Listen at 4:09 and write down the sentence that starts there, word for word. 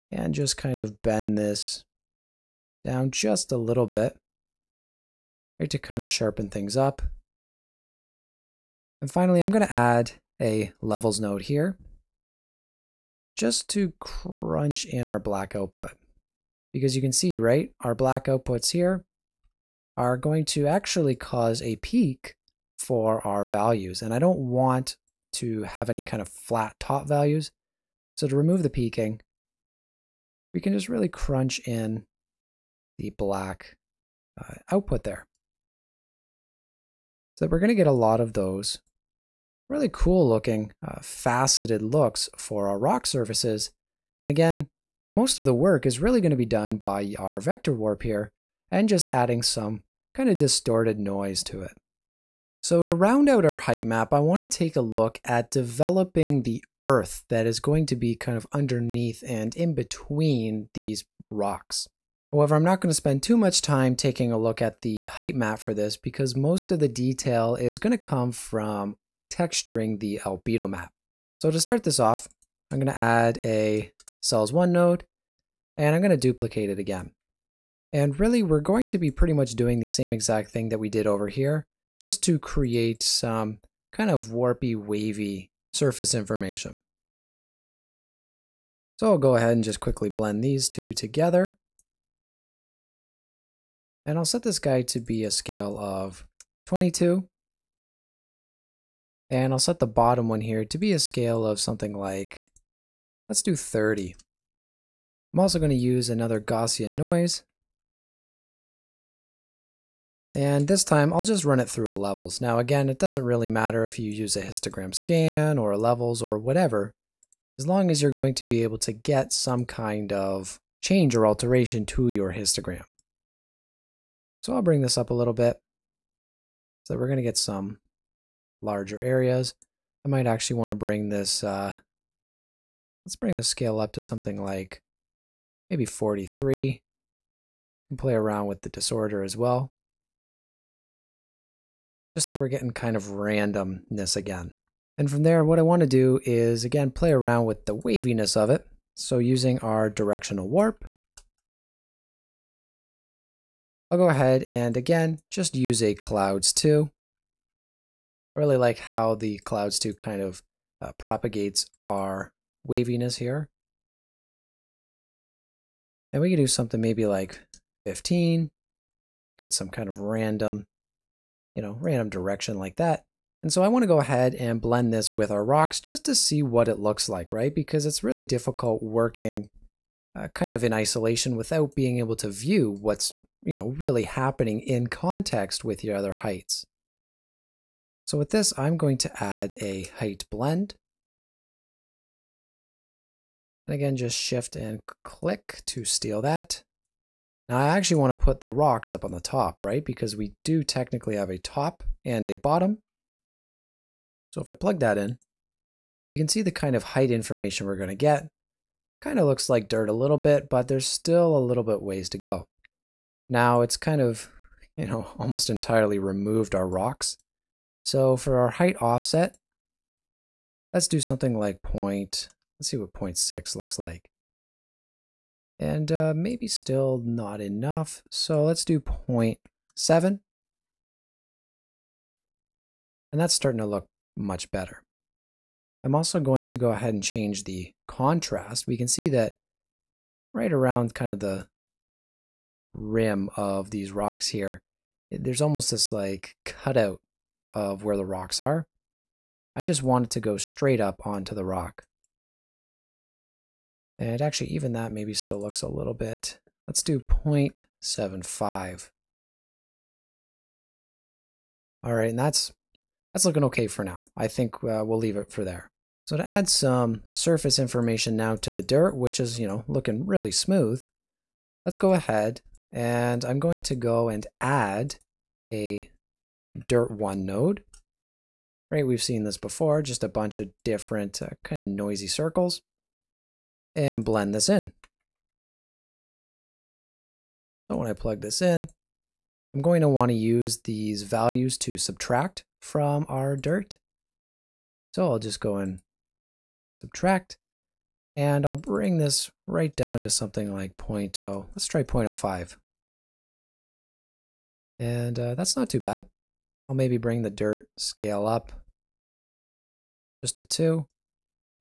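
I just want it to go straight up onto the rock.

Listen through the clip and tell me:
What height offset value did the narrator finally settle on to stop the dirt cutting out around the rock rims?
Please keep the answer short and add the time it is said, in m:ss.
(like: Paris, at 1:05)
0.75, at 4:16.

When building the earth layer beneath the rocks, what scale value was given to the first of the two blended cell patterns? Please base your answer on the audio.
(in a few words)
22.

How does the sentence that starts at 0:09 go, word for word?
And finally, I'm going to add a levels node here just to crunch in our black output.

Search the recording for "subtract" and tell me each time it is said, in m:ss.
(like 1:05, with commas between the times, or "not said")
4:51, 4:56.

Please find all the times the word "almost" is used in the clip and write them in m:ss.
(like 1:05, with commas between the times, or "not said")
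3:35, 4:05.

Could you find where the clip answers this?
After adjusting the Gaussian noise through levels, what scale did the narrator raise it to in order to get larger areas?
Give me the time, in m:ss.
2:15.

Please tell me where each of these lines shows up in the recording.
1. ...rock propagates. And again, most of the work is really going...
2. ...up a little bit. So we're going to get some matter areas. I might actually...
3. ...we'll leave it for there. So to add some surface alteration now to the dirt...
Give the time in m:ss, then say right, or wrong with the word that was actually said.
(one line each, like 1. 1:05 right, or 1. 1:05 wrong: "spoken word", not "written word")
1. 0:42 wrong: "surfaces", not "propagates"
2. 2:04 wrong: "larger", not "matter"
3. 4:24 wrong: "information", not "alteration".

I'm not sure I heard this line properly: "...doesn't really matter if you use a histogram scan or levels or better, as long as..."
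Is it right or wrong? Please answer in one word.
wrong.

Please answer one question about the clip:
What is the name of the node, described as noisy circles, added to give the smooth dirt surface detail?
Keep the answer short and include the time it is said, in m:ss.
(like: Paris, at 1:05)
dirt one, at 4:36.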